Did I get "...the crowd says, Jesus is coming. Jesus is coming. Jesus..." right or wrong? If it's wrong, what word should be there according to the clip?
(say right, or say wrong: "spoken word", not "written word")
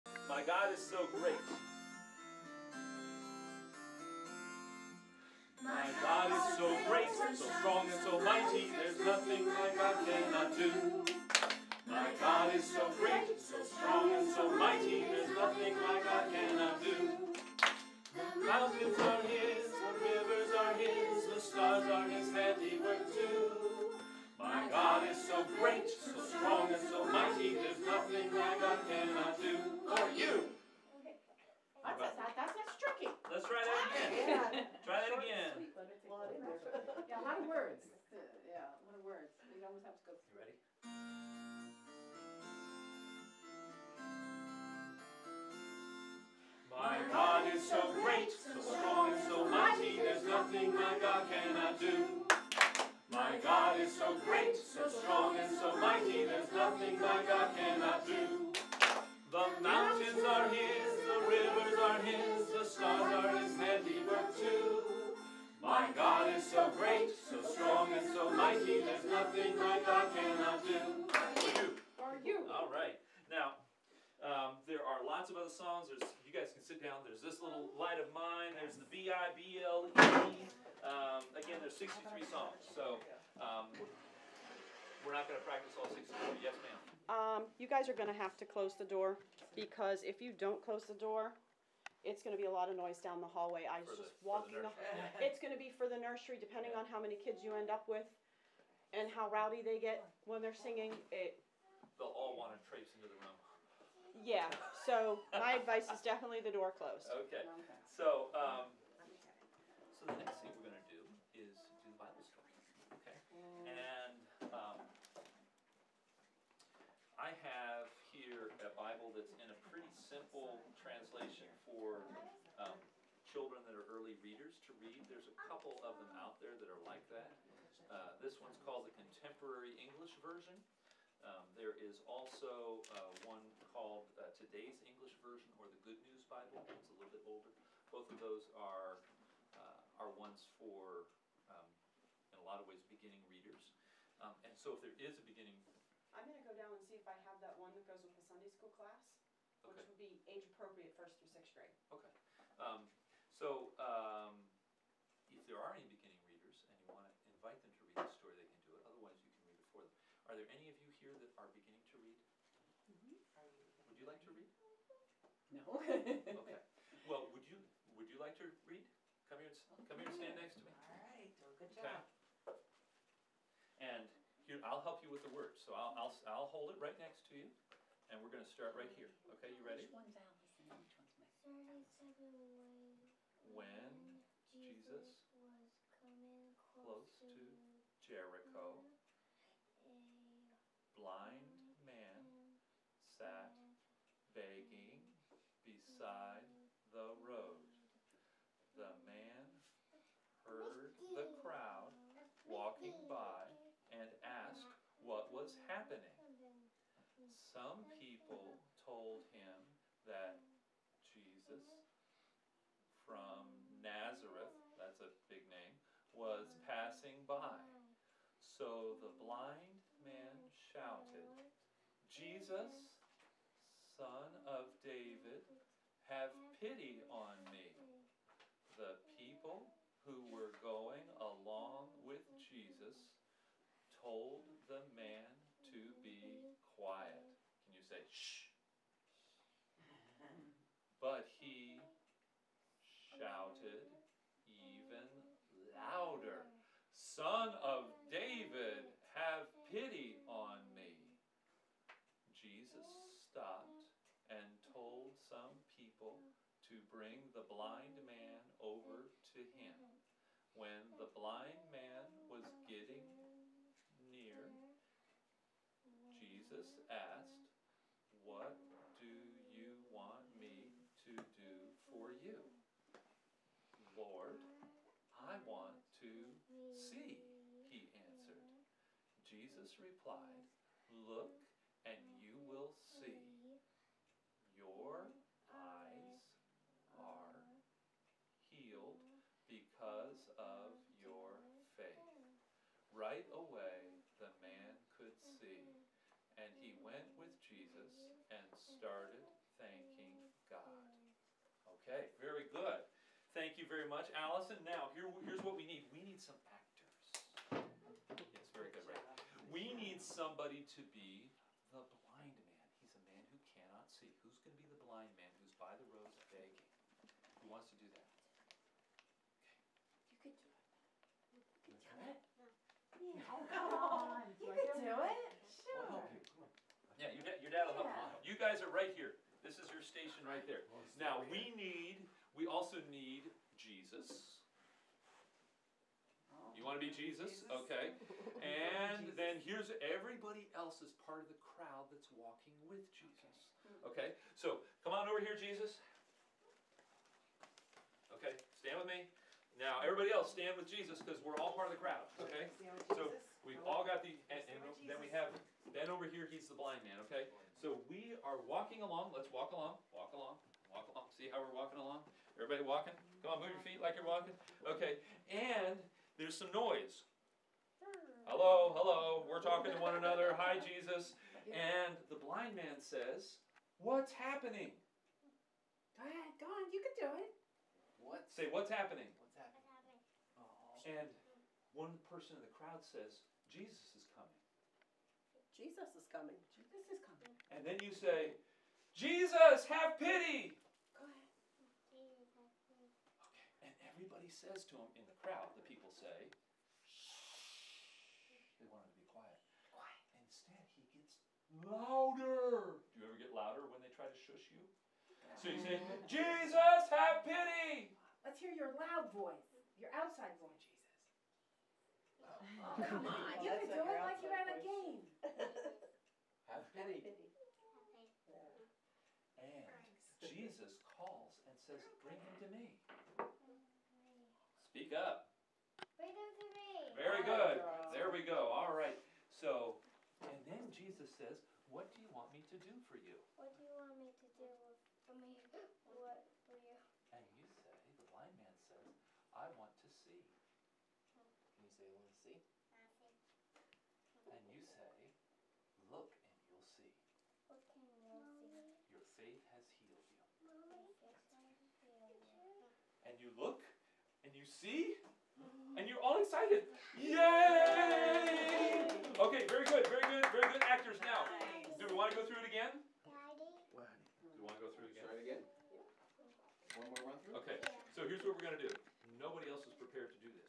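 right.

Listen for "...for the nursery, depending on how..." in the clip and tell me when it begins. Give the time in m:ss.
1:35.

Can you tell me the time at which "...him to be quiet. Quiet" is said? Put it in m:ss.
6:38.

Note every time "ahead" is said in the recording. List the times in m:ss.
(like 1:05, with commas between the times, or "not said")
6:16, 6:31.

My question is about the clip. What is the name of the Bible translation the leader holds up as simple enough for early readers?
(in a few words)
Contemporary English Version.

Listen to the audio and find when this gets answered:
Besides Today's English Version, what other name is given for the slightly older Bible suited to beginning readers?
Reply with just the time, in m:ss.
2:15.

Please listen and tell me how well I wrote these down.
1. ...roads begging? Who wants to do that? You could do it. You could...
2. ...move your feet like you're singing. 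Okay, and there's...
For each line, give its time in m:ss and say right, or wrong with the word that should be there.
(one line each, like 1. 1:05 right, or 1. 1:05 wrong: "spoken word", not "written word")
1. 5:15 right
2. 6:03 wrong: "walking", not "singing".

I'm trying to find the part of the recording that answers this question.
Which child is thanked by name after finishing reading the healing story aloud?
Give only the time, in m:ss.
5:04.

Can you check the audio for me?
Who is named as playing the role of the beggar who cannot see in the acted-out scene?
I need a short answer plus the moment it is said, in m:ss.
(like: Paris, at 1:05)
Ben, at 5:55.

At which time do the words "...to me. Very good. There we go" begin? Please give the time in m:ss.
7:06.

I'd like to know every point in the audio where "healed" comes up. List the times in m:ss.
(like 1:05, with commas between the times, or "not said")
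4:48, 7:29.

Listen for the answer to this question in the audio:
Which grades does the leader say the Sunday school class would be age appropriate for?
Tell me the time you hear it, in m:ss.
2:30.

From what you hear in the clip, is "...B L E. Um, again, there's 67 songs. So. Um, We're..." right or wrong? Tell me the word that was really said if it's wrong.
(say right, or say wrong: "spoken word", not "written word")
wrong: "63", not "67".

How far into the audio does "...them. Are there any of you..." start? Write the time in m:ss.
2:39.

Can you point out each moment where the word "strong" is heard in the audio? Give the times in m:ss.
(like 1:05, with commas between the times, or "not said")
0:07, 0:13, 0:26, 0:54, 1:07.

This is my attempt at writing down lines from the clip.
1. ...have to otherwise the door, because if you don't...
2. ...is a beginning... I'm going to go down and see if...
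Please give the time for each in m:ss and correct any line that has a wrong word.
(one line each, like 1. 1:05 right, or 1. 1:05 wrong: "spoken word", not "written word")
1. 1:28 wrong: "close", not "otherwise"
2. 2:25 right.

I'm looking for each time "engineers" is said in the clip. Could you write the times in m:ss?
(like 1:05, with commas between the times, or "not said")
not said.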